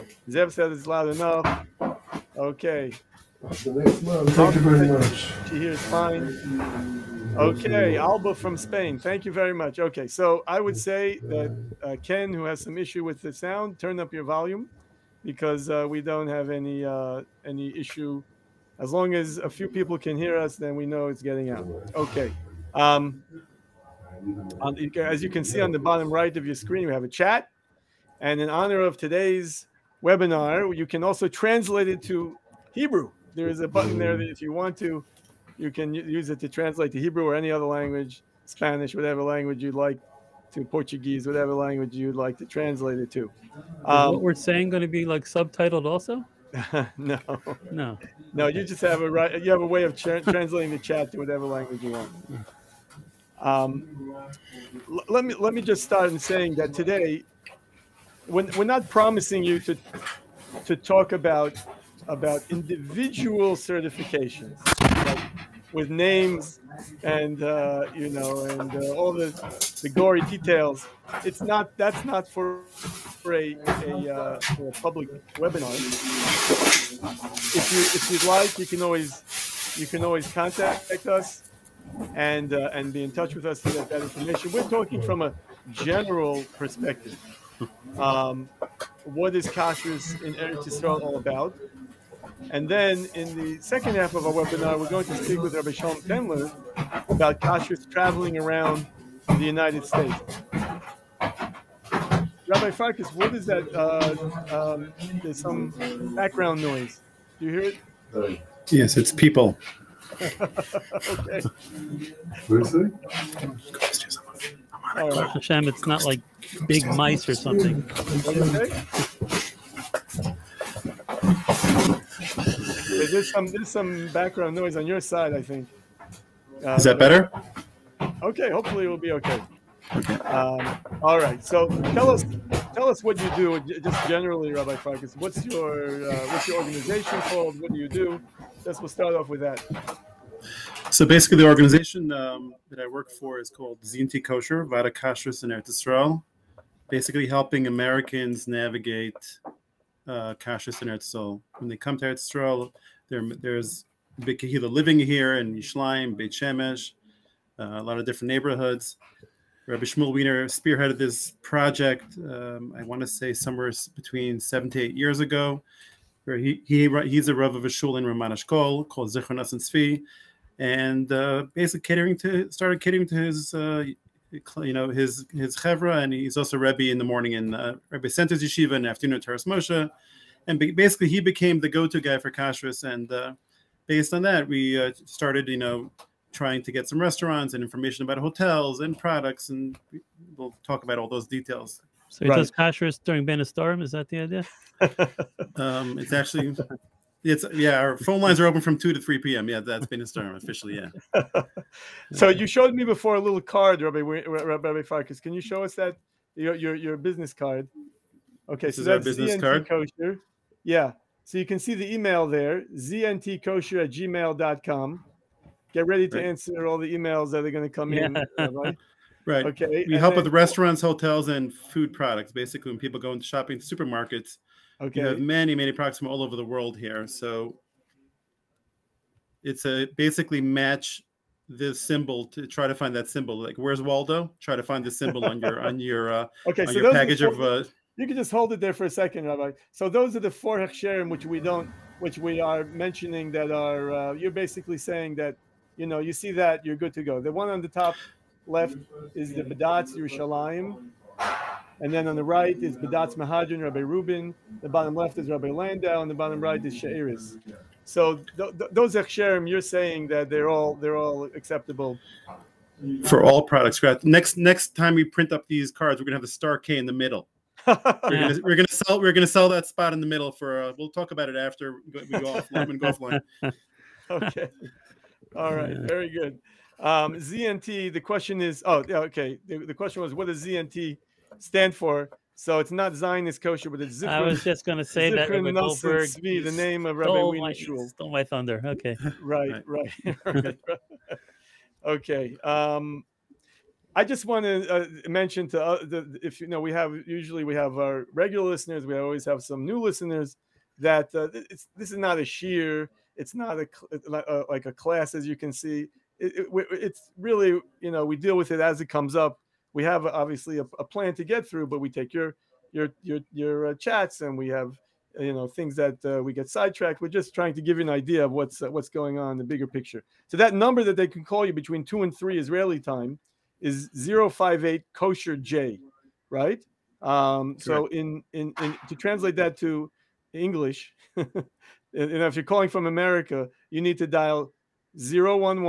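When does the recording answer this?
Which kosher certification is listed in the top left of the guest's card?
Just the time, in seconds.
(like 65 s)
249 s.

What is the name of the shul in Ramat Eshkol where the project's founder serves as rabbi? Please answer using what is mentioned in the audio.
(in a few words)
Zichron Tzvi.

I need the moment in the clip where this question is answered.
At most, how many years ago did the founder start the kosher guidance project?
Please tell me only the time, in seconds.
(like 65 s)
164 s.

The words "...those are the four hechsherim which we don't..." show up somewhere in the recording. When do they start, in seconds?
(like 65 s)
239 s.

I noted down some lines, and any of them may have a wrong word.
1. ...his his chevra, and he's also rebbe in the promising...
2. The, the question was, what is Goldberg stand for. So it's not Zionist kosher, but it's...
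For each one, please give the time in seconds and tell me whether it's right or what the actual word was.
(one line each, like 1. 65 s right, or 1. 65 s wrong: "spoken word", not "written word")
1. 174 s wrong: "morning", not "promising"
2. 279 s wrong: "ZNT", not "Goldberg".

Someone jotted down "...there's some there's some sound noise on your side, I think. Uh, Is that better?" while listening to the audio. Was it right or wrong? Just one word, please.
wrong.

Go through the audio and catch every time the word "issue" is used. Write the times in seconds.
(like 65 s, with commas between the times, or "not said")
12 s, 17 s.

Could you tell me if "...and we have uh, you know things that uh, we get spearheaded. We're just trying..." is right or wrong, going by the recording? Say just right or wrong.
wrong.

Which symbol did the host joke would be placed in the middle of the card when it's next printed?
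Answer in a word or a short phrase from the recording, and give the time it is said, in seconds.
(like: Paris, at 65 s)
Star K, at 266 s.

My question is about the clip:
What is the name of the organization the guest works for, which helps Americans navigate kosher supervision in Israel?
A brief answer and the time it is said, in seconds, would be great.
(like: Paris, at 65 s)
ZNT Kosher, at 143 s.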